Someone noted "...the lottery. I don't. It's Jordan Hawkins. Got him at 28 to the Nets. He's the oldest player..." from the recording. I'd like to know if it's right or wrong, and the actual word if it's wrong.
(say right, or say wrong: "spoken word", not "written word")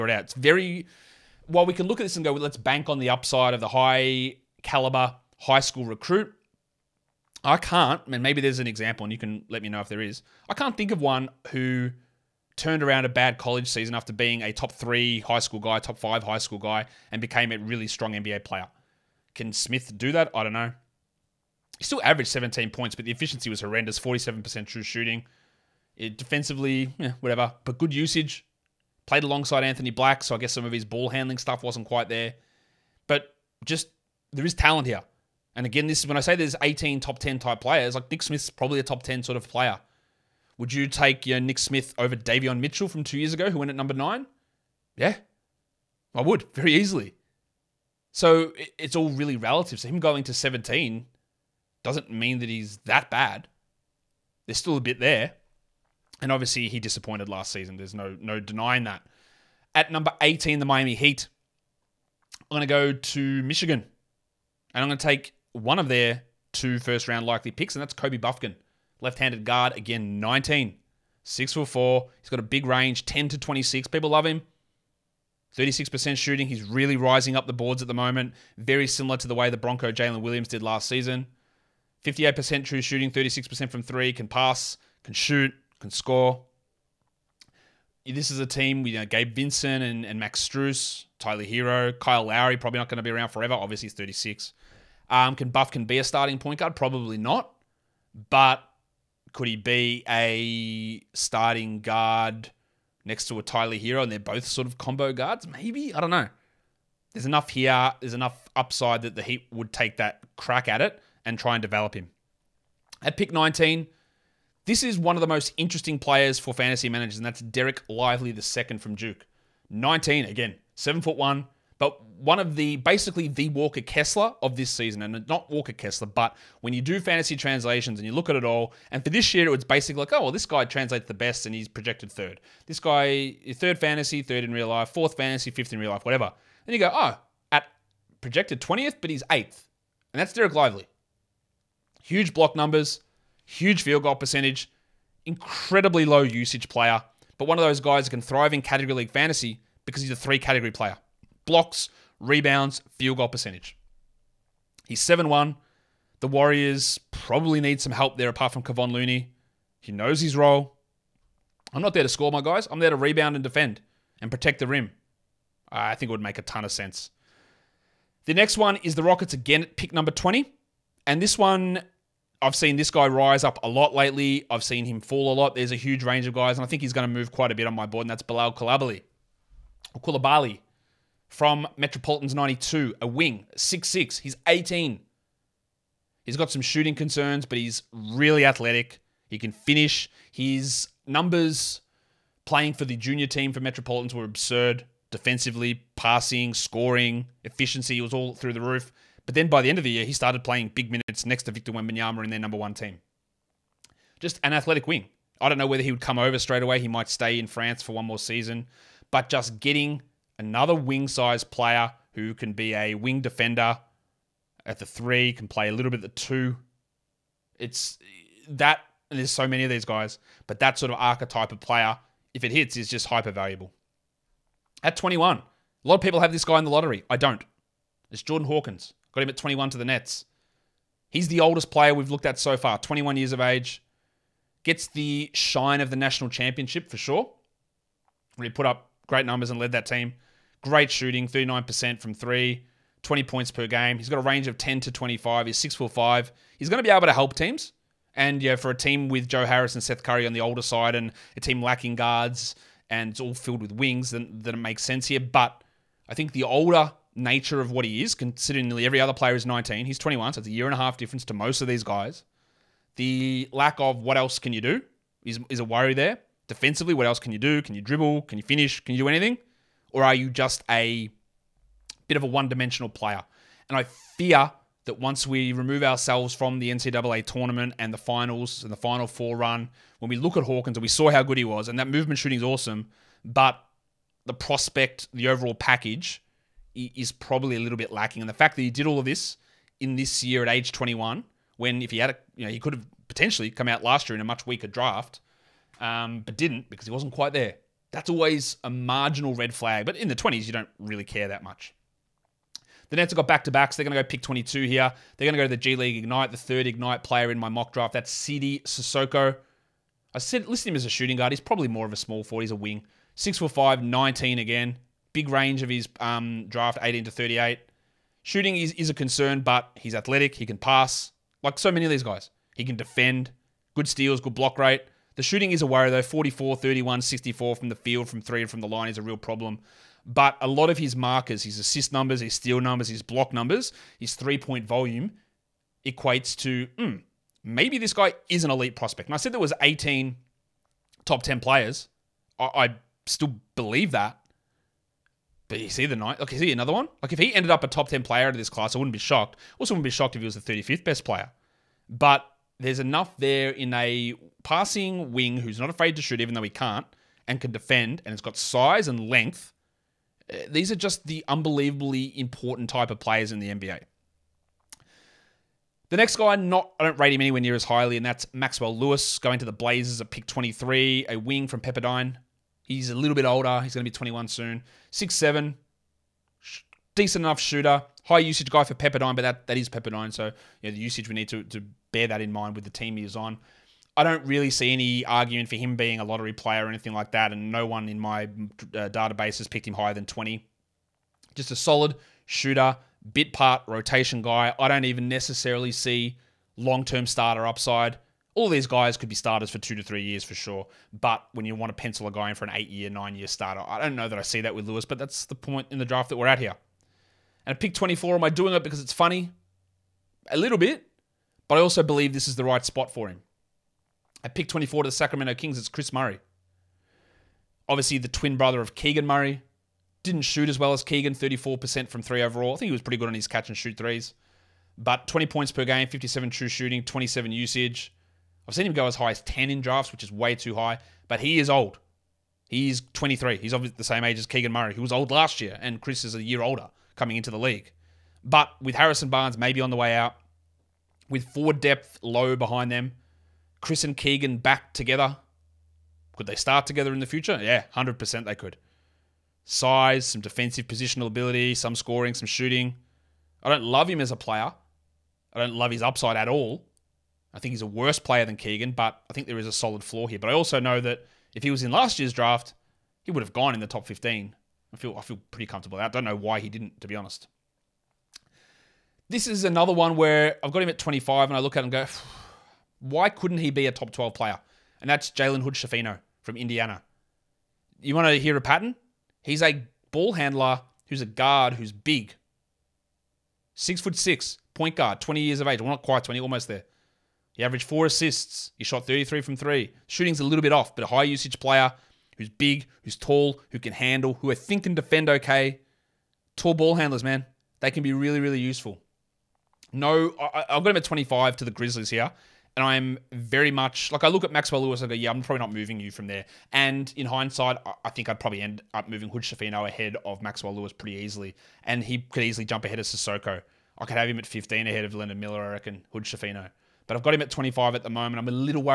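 wrong: "21", not "28".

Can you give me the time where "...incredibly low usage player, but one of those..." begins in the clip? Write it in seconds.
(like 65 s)
145 s.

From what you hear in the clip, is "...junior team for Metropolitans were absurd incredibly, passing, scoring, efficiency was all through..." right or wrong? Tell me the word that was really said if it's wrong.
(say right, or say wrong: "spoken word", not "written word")
wrong: "defensively", not "incredibly".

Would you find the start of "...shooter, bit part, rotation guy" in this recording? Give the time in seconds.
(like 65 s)
392 s.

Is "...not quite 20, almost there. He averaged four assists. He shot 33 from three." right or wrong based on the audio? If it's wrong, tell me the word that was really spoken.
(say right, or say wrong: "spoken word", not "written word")
right.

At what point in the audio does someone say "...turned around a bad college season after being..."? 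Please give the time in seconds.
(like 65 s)
12 s.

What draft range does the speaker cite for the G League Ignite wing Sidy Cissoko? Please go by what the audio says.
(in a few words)
18 to 38.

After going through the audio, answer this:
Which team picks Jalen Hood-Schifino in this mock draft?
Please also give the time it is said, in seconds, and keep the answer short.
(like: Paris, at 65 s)
Grizzlies, at 501 s.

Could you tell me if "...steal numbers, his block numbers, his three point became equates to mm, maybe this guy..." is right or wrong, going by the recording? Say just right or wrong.
wrong.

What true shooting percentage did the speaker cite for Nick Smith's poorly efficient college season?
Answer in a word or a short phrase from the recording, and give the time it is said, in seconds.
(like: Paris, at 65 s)
47%, at 23 s.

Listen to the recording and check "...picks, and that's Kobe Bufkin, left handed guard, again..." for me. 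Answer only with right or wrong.
right.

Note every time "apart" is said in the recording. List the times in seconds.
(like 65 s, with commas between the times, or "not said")
158 s.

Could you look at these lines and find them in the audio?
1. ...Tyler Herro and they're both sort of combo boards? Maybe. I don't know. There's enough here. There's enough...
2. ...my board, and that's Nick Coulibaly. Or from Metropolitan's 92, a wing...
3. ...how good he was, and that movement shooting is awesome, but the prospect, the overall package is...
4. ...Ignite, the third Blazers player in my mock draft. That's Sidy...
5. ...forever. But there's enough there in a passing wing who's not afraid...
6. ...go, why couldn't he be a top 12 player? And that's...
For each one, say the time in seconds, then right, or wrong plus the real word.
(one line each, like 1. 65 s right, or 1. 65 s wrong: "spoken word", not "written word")
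1. 103 s wrong: "guards", not "boards"
2. 177 s wrong: "Bilal", not "Nick"
3. 281 s right
4. 305 s wrong: "Ignite", not "Blazers"
5. 351 s wrong: "player", not "forever"
6. 471 s right.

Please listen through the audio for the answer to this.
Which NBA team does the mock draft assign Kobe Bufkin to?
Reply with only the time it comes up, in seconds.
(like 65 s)
60 s.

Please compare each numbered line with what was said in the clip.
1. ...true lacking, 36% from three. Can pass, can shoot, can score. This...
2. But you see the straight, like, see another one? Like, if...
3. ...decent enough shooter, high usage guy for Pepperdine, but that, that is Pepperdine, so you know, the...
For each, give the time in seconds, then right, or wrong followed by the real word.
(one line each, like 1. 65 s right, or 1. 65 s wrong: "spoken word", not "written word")
1. 82 s wrong: "shooting", not "lacking"
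2. 345 s wrong: "night", not "straight"
3. 376 s right.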